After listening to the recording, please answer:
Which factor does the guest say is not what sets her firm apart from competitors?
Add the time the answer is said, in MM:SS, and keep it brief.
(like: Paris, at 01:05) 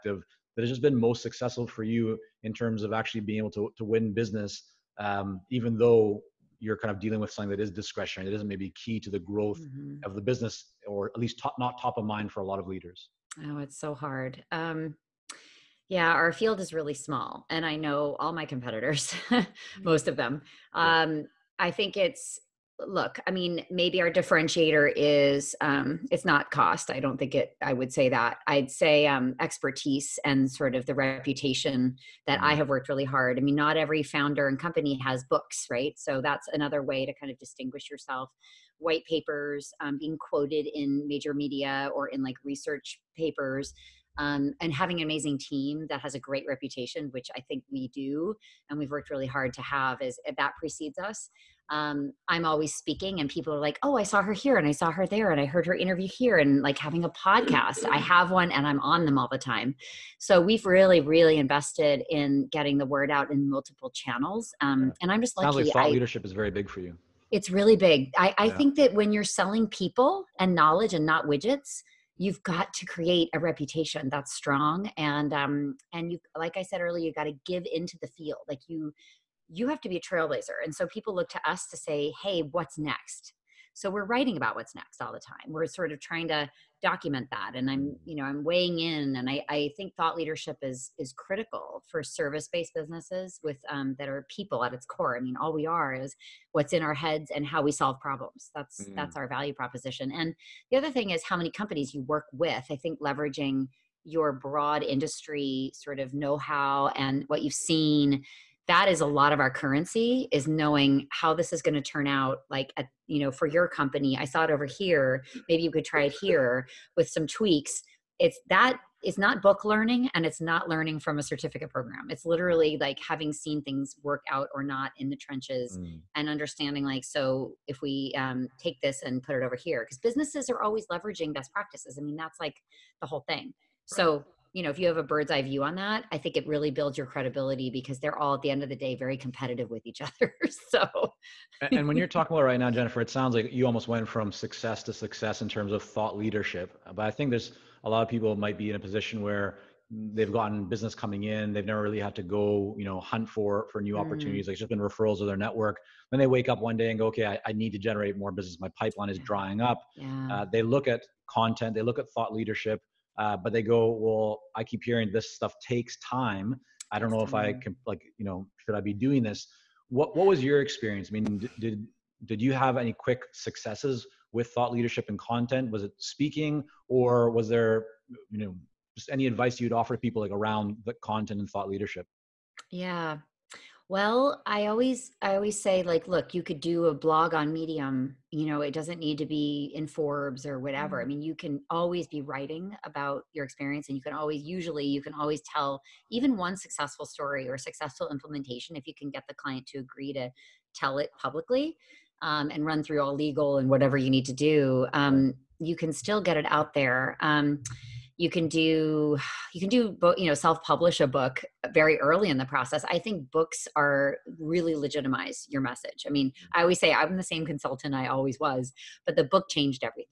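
Cost, at 00:26.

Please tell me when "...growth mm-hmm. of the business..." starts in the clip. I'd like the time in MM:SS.
00:09.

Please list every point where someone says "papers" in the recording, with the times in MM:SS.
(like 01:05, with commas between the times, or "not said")
00:39, 00:43.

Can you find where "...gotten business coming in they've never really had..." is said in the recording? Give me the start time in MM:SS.
02:30.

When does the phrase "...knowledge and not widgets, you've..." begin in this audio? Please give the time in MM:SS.
01:10.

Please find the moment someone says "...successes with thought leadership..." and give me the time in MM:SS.
02:53.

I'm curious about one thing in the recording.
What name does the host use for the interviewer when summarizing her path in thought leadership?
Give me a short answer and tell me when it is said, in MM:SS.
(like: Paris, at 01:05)
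Jennifer, at 02:22.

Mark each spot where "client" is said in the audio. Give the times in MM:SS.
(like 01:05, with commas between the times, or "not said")
03:19.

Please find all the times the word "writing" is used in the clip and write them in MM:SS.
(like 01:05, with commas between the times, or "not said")
01:24, 03:12.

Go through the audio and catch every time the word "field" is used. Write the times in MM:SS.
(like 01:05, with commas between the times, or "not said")
00:16, 01:18.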